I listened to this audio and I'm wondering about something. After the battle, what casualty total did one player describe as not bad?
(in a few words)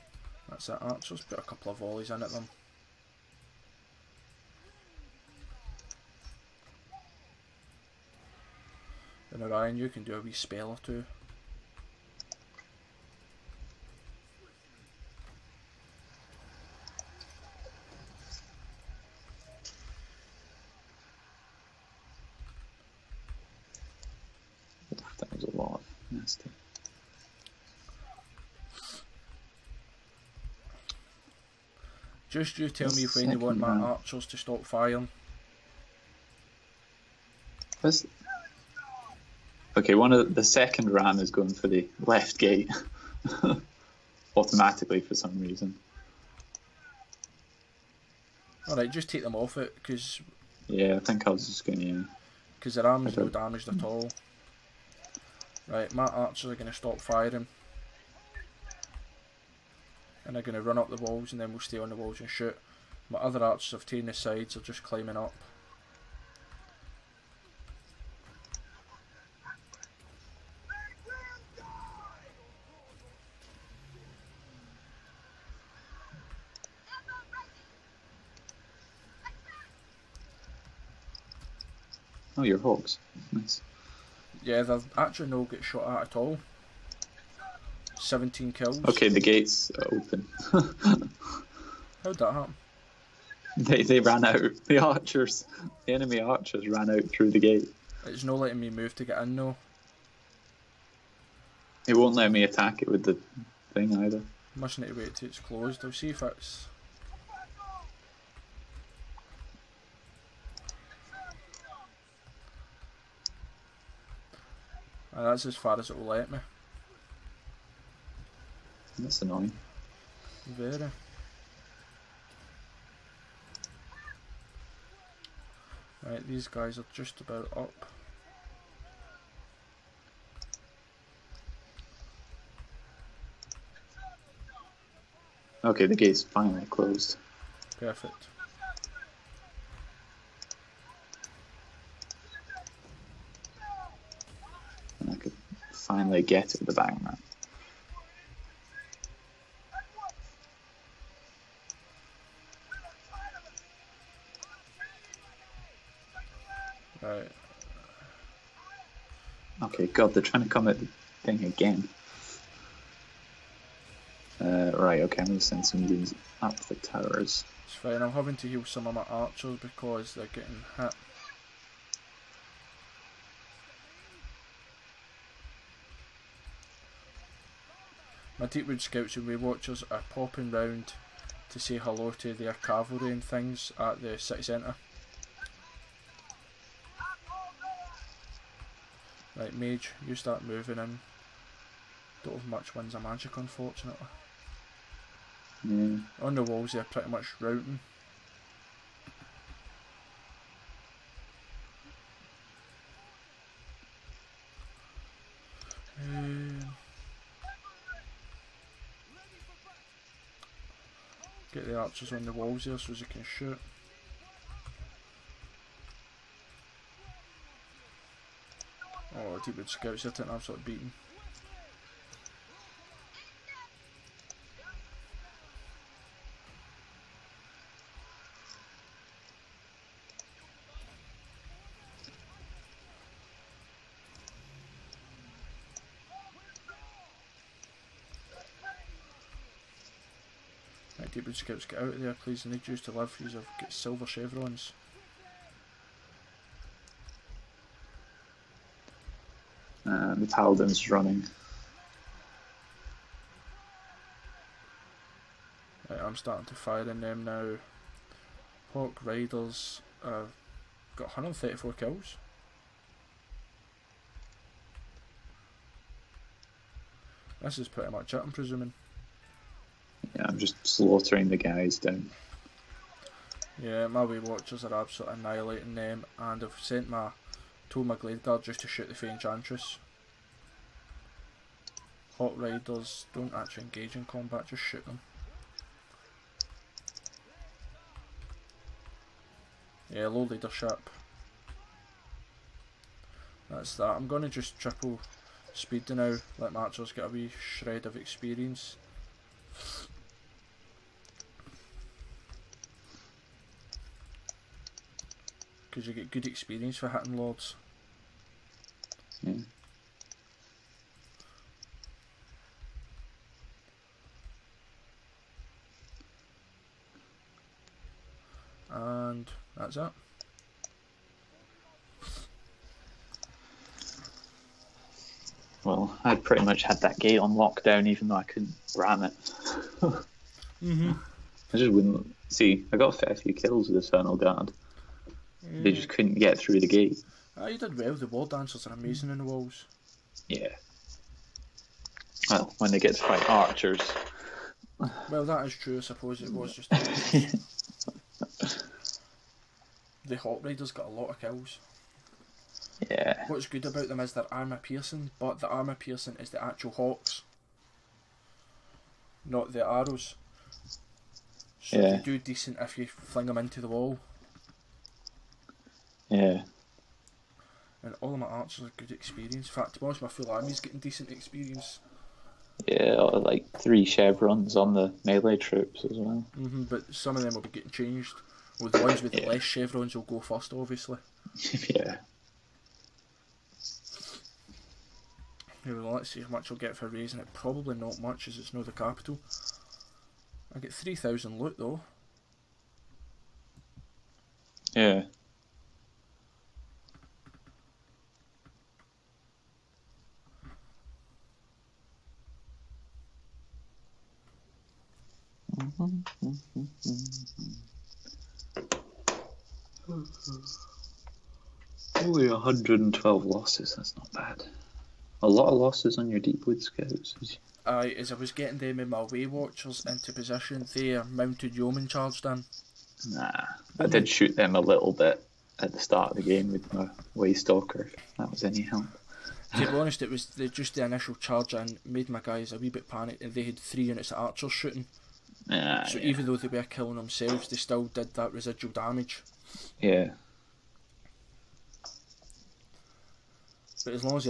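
112.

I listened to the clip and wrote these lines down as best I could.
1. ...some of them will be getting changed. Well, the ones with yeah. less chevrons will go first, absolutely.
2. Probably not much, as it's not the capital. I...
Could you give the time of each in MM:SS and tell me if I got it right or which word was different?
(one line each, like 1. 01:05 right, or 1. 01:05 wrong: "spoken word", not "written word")
1. 06:16 wrong: "obviously", not "absolutely"
2. 06:27 right.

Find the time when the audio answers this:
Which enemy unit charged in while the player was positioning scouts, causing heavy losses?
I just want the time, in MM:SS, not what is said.
07:01.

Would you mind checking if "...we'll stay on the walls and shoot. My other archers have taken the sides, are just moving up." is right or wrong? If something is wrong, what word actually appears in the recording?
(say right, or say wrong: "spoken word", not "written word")
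wrong: "climbing", not "moving".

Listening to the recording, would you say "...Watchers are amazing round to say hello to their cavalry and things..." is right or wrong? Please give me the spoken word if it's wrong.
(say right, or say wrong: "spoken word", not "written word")
wrong: "popping", not "amazing".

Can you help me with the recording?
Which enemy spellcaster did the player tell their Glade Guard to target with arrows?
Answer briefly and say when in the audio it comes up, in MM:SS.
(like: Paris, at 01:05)
Fey Enchantress, at 04:38.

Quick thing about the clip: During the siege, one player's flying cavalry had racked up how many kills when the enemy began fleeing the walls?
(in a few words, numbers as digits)
134.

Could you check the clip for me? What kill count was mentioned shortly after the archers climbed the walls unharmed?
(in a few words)
17.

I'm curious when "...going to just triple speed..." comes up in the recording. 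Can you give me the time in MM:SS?
04:54.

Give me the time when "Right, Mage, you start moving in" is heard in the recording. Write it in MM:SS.
03:09.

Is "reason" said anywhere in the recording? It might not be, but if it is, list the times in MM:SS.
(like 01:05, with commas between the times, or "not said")
00:45.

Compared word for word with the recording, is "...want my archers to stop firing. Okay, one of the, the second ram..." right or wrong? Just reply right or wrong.
right.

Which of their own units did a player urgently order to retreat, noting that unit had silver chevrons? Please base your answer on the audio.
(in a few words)
Wood Scouts.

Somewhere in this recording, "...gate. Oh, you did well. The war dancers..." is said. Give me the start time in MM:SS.
05:36.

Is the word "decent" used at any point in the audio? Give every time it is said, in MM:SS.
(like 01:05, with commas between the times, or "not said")
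06:02, 06:10.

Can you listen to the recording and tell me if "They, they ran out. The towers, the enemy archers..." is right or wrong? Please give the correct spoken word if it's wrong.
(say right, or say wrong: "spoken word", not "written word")
wrong: "archers", not "towers".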